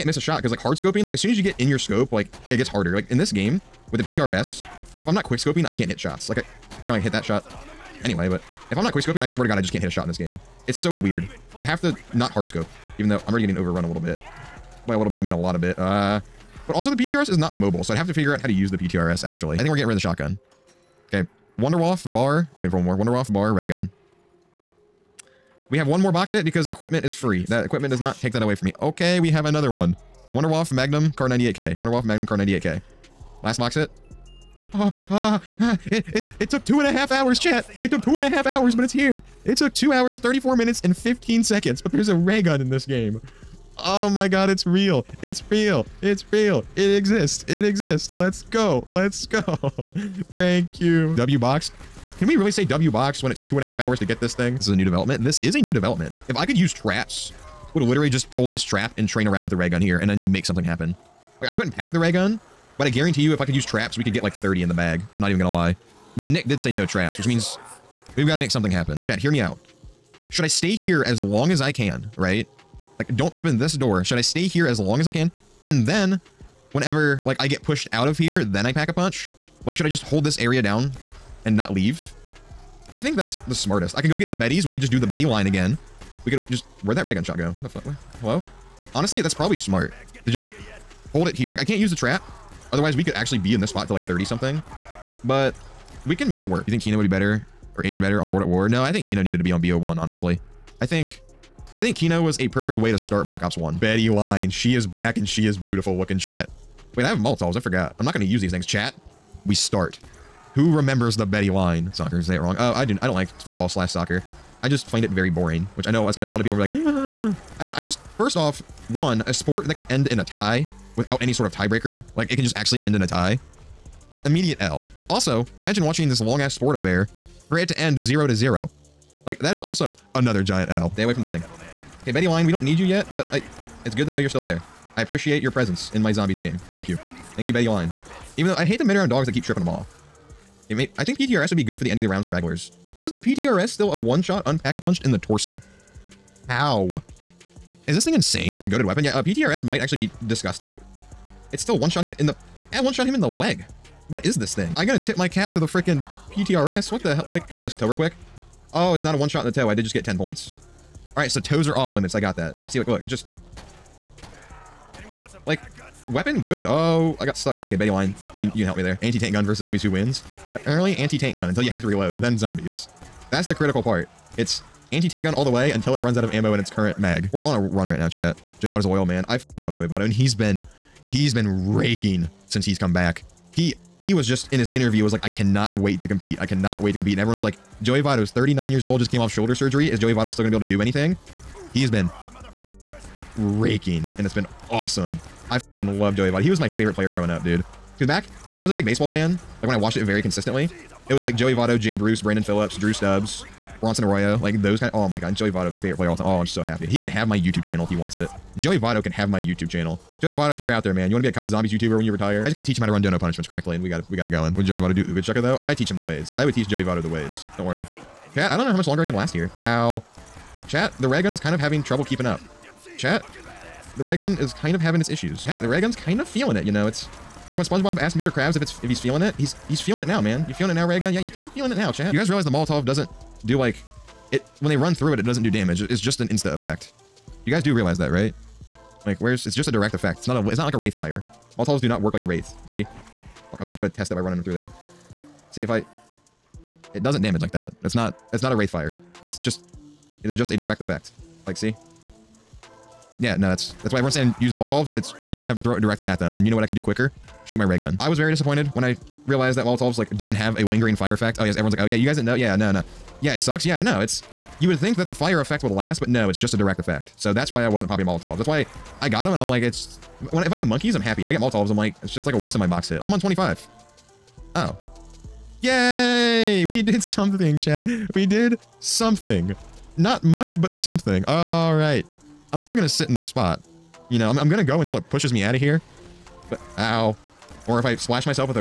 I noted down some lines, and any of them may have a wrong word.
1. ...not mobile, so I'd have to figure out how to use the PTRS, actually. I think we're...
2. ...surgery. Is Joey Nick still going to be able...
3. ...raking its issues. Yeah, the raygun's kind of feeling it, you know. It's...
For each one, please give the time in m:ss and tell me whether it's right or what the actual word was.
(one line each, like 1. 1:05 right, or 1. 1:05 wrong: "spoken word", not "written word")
1. 0:17 right
2. 3:09 wrong: "Votto", not "Nick"
3. 3:44 wrong: "having", not "raking".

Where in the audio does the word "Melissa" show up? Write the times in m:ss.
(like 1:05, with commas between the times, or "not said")
not said.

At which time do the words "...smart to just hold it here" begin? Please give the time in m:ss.
1:29.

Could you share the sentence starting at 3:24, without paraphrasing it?
Of, oh my god, Joey Votto, my favorite player all time.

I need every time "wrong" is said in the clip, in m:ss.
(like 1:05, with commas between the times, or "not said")
1:52.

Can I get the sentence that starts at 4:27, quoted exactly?
So that's why I wasn't popping Molotovs.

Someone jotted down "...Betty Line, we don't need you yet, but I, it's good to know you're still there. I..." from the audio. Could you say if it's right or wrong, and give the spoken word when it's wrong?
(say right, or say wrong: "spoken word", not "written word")
right.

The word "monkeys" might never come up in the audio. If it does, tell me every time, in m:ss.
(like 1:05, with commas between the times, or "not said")
4:30.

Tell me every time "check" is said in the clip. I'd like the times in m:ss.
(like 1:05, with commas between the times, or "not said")
not said.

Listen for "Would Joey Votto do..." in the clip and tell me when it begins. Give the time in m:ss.
3:34.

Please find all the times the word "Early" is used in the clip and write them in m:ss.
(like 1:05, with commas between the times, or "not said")
2:50.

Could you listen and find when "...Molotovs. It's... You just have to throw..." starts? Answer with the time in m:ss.
4:14.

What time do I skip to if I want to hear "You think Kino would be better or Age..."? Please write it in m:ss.
1:36.